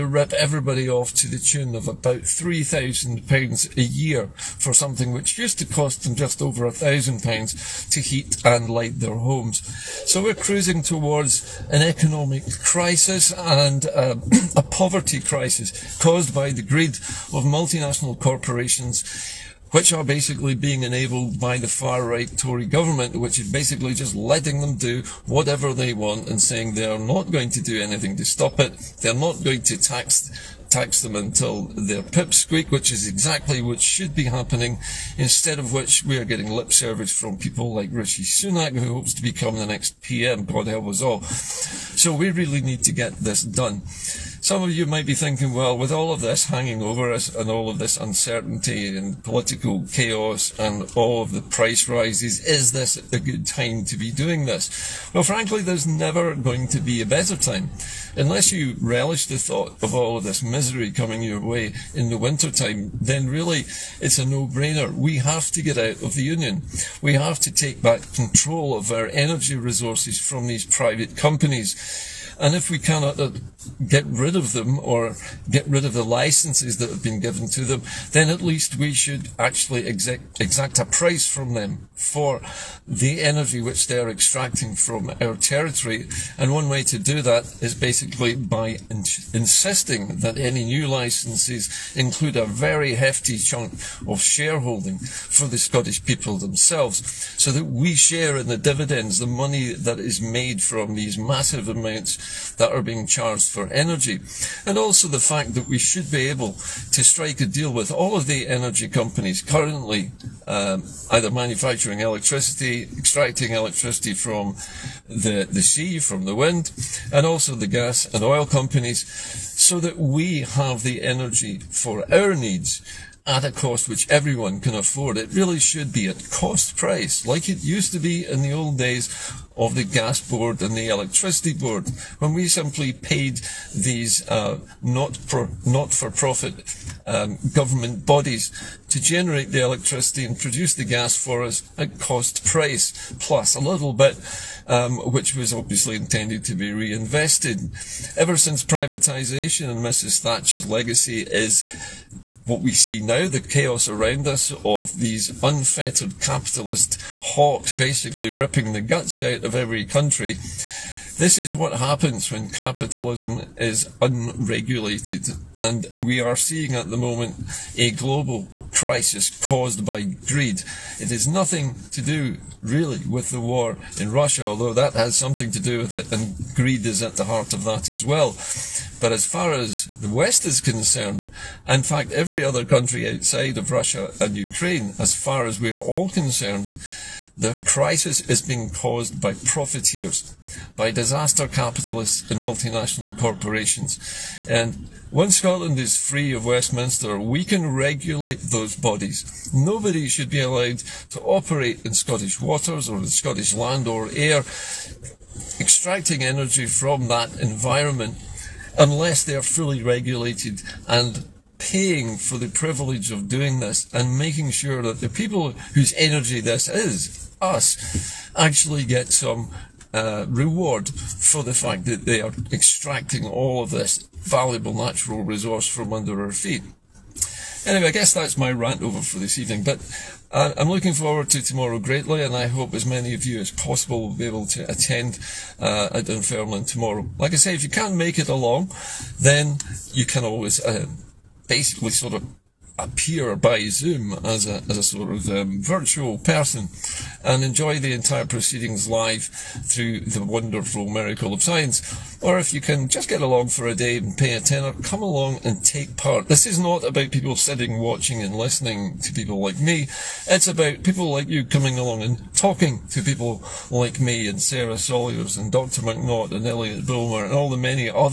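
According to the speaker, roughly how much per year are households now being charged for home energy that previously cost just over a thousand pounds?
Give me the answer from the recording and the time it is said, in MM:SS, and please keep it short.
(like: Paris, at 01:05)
£3,000, at 00:02.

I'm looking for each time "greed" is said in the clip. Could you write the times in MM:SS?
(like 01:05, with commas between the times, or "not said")
00:16, 02:50, 02:56.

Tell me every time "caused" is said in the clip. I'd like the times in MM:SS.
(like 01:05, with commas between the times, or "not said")
00:16, 02:49, 03:08.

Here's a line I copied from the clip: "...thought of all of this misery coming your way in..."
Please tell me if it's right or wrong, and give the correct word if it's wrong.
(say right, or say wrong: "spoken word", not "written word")
right.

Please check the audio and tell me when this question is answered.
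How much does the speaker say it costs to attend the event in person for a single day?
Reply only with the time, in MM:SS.
04:14.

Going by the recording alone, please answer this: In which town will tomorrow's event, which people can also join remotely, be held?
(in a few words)
Dunfermline.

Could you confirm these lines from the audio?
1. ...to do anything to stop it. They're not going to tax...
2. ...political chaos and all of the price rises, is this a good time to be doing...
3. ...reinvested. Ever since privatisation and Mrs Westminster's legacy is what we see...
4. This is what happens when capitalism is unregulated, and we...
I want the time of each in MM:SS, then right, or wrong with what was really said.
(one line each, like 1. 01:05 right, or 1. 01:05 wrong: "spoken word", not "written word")
1. 00:27 right
2. 00:49 right
3. 02:26 wrong: "Thatcher", not "Westminster"
4. 02:41 right.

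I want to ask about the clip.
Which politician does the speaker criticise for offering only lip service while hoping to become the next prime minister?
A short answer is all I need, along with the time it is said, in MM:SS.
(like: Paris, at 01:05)
Rishi Sunak, at 00:37.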